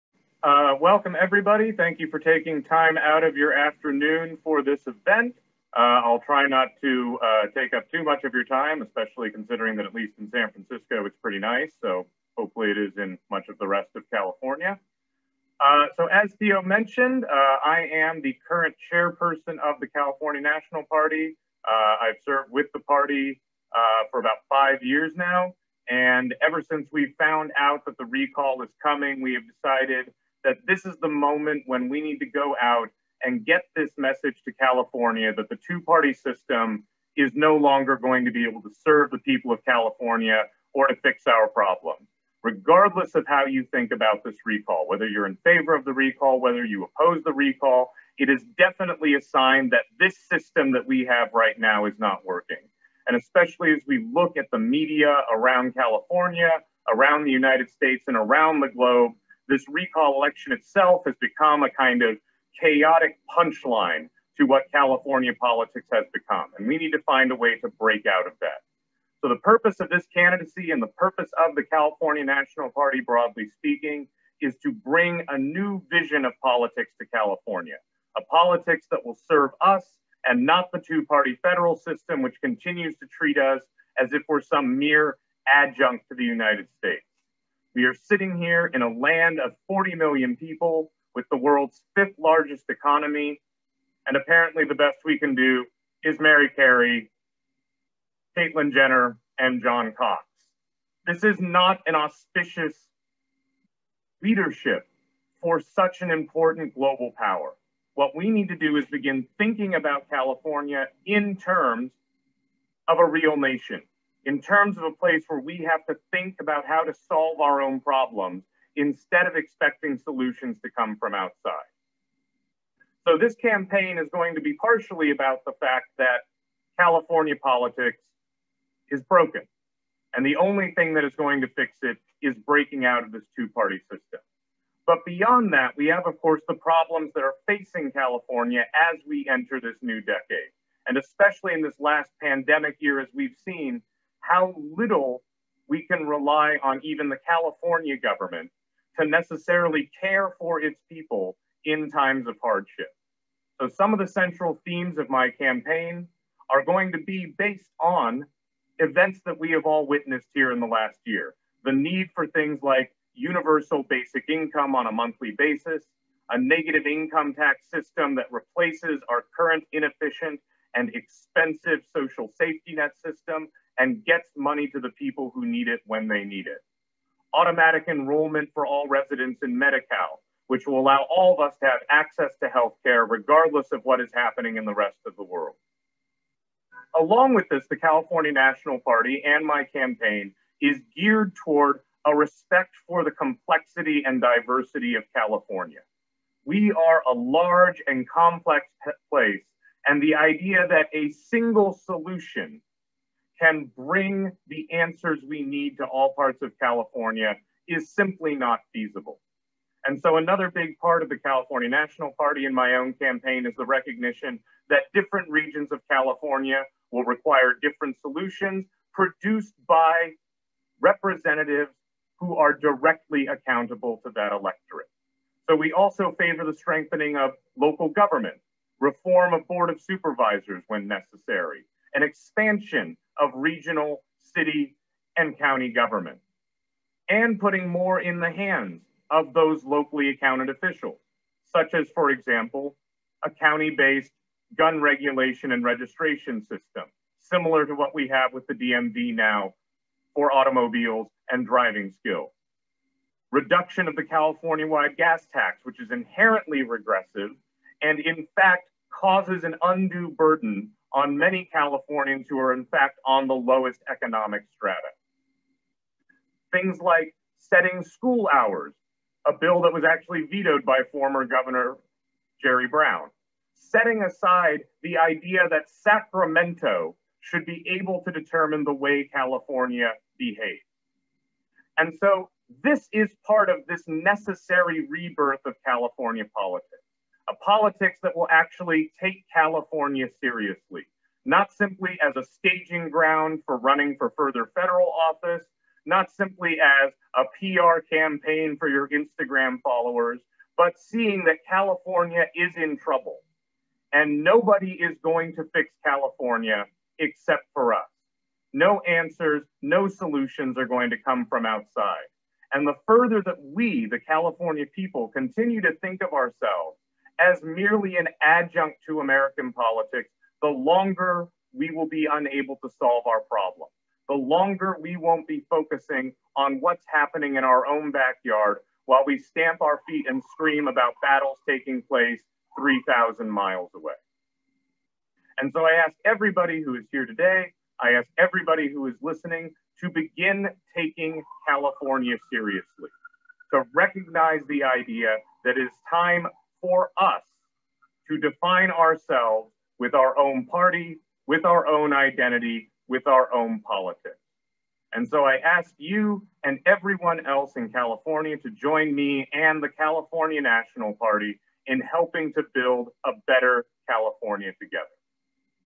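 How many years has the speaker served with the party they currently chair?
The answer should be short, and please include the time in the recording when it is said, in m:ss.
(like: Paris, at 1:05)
5 years, at 0:24.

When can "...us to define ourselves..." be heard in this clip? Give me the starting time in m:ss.
5:46.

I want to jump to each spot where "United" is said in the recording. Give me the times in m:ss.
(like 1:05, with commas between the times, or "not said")
0:57, 1:26.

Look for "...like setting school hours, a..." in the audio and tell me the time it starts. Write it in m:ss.
4:26.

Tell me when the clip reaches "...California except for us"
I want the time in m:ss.
5:05.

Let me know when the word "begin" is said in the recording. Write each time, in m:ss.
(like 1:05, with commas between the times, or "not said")
1:48, 5:39.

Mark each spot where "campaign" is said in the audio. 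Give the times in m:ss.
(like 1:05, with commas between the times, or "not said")
2:03, 2:35, 3:09, 3:32, 4:57.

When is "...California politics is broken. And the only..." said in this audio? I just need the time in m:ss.
2:06.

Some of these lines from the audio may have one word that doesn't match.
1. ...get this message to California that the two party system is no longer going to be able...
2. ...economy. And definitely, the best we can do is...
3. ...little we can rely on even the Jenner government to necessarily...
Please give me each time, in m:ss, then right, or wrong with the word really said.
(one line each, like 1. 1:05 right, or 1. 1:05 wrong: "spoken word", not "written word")
1. 0:33 right
2. 1:32 wrong: "apparently", not "definitely"
3. 2:24 wrong: "California", not "Jenner".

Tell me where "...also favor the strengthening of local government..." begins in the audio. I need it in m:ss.
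3:45.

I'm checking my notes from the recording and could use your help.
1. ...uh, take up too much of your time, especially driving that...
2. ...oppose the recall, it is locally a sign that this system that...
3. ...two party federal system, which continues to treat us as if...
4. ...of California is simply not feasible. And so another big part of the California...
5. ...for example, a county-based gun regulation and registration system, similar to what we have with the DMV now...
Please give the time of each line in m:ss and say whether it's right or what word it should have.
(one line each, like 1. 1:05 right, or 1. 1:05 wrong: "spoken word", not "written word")
1. 0:07 wrong: "considering", not "driving"
2. 0:46 wrong: "definitely", not "locally"
3. 1:20 right
4. 3:26 right
5. 4:01 right.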